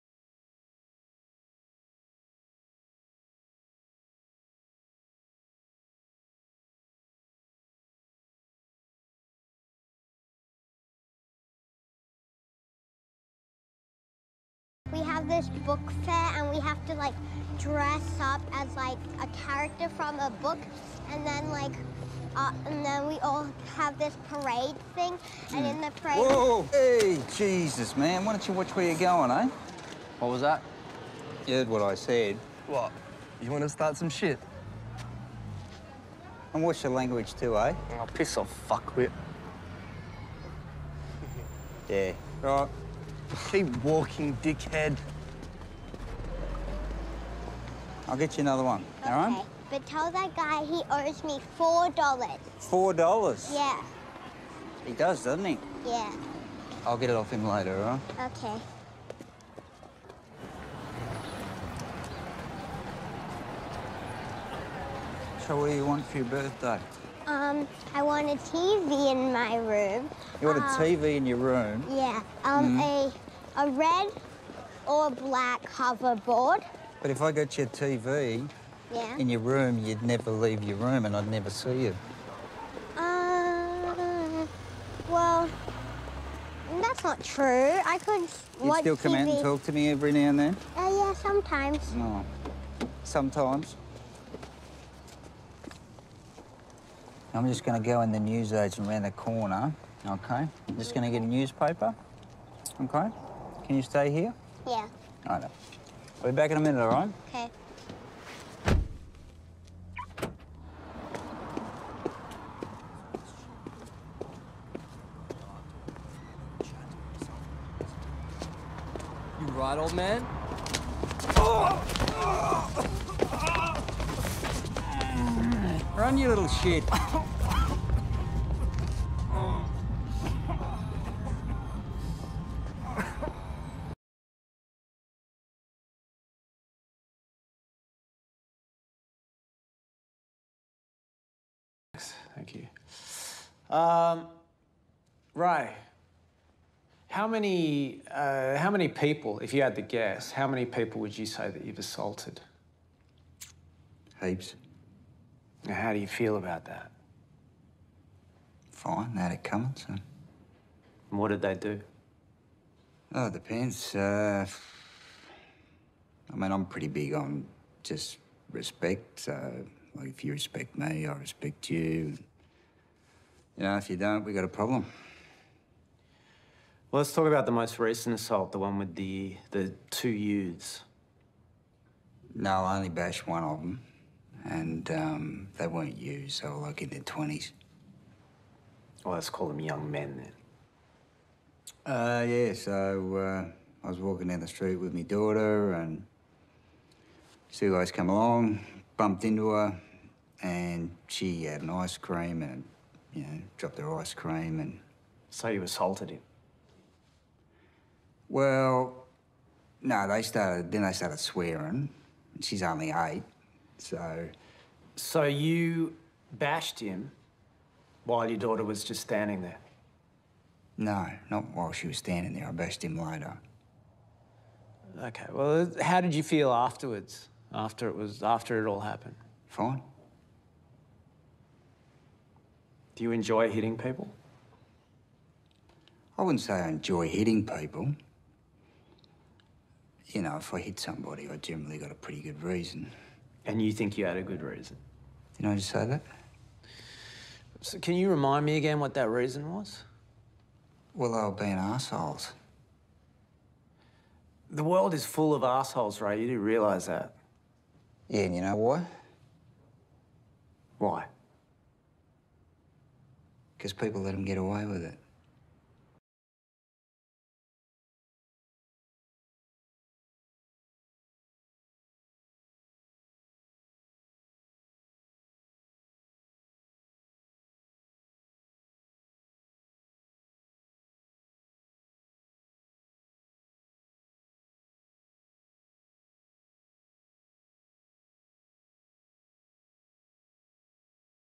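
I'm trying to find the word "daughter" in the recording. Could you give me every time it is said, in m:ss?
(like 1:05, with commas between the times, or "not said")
3:15, 3:38.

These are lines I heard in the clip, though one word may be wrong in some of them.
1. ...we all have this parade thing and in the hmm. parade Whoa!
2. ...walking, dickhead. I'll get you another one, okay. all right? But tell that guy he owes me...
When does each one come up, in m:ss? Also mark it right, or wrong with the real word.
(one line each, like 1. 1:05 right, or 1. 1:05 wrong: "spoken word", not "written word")
1. 0:23 right
2. 0:43 right.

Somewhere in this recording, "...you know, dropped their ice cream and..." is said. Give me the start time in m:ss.
3:23.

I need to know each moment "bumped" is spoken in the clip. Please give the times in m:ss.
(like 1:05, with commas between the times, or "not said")
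3:18.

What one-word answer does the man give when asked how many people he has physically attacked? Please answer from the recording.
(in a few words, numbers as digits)
Heaps.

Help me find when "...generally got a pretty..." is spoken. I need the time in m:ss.
4:01.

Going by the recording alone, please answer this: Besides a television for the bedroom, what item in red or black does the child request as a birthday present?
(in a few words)
hoverboard.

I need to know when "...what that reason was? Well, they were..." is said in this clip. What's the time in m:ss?
4:08.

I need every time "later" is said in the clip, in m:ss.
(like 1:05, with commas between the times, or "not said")
0:57, 3:42.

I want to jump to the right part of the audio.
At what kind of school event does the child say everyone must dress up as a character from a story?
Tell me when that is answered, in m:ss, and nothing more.
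0:15.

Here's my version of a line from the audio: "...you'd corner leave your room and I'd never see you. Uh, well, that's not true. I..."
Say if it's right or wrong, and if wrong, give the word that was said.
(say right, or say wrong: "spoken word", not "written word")
wrong: "never", not "corner".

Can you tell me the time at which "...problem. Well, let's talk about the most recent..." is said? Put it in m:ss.
2:54.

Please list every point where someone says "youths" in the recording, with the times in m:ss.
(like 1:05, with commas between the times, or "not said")
3:00, 3:05.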